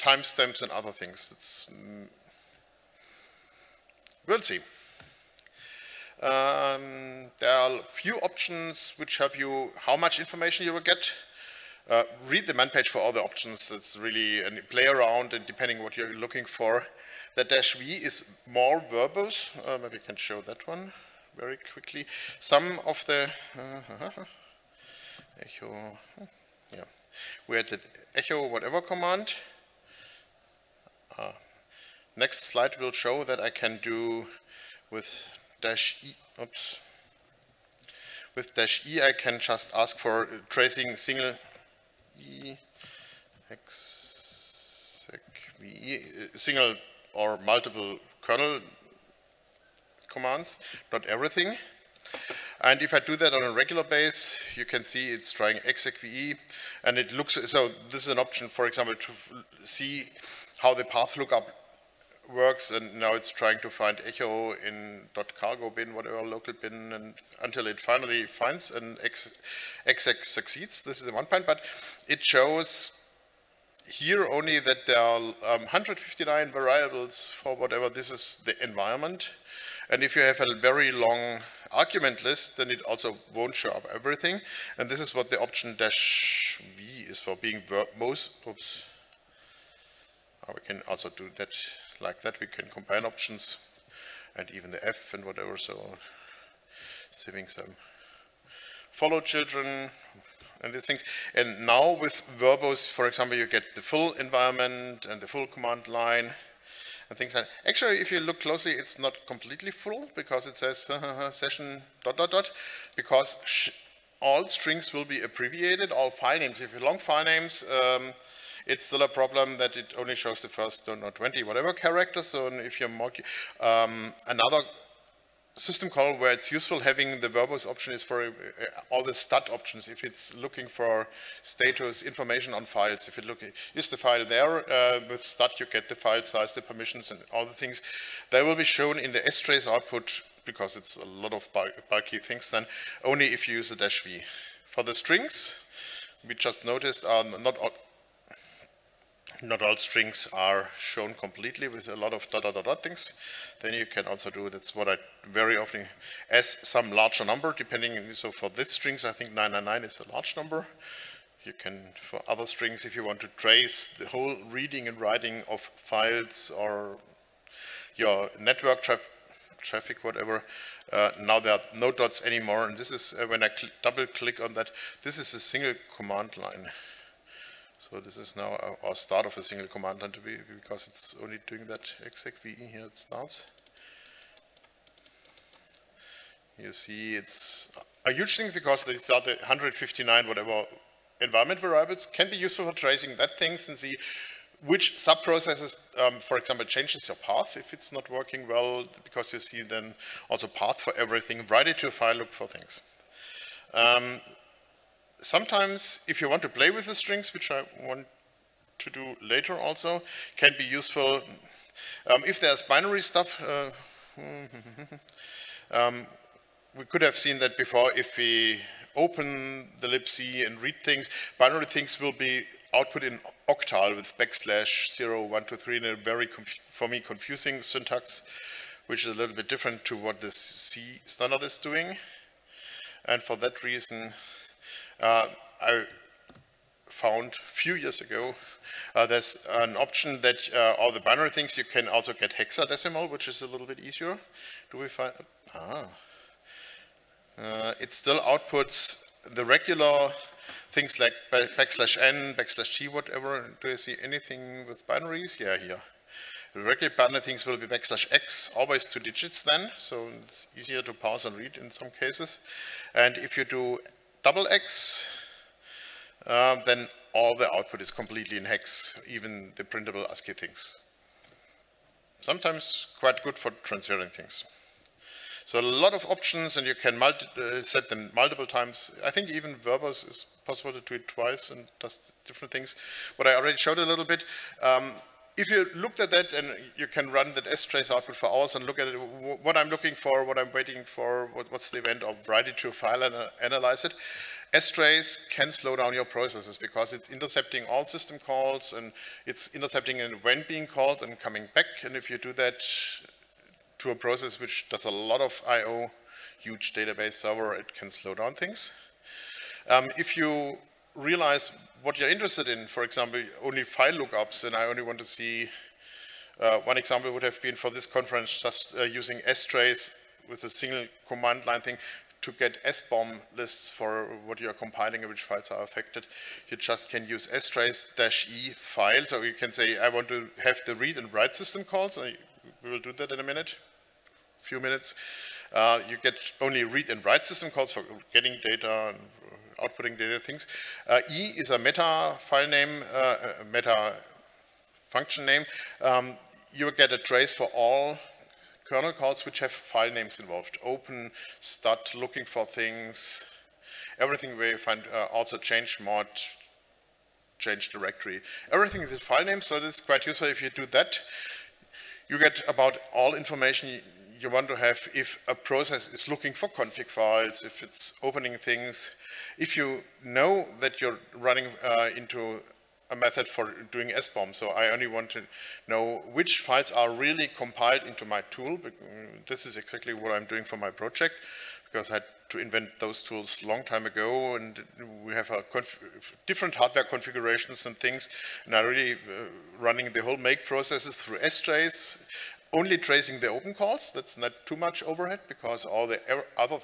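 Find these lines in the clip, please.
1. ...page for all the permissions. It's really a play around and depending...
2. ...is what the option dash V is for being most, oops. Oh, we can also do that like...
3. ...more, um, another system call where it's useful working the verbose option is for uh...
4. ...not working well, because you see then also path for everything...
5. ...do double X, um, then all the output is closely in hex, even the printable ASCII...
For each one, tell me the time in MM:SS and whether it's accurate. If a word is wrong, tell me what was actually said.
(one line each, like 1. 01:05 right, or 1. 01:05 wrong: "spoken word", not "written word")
1. 00:12 wrong: "options", not "permissions"
2. 01:24 right
3. 02:02 wrong: "having", not "working"
4. 03:17 right
5. 04:23 wrong: "completely", not "closely".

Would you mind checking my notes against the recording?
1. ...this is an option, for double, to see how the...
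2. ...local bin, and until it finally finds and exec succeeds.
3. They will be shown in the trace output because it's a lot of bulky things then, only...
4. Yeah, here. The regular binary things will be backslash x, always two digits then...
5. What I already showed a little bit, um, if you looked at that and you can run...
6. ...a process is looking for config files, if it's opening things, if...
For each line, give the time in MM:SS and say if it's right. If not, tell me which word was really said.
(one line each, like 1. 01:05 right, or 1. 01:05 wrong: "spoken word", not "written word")
1. 00:57 wrong: "example", not "double"
2. 01:06 right
3. 02:18 right
4. 04:15 right
5. 04:43 right
6. 06:05 right.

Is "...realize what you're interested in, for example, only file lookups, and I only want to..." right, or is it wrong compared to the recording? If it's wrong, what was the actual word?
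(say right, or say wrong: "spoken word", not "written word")
right.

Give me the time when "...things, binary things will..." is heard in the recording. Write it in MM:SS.
03:40.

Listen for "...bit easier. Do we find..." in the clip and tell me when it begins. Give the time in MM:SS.
04:03.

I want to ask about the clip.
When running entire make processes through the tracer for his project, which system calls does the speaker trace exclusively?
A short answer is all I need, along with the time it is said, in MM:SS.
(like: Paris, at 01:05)
open calls, at 06:33.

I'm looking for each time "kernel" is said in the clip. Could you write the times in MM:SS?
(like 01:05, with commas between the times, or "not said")
00:48, 05:48.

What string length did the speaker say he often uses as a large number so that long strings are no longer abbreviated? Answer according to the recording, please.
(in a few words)
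999.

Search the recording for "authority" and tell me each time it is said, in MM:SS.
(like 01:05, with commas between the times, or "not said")
not said.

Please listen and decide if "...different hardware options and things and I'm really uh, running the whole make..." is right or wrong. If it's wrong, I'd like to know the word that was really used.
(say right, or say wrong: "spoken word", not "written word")
wrong: "configurations", not "options".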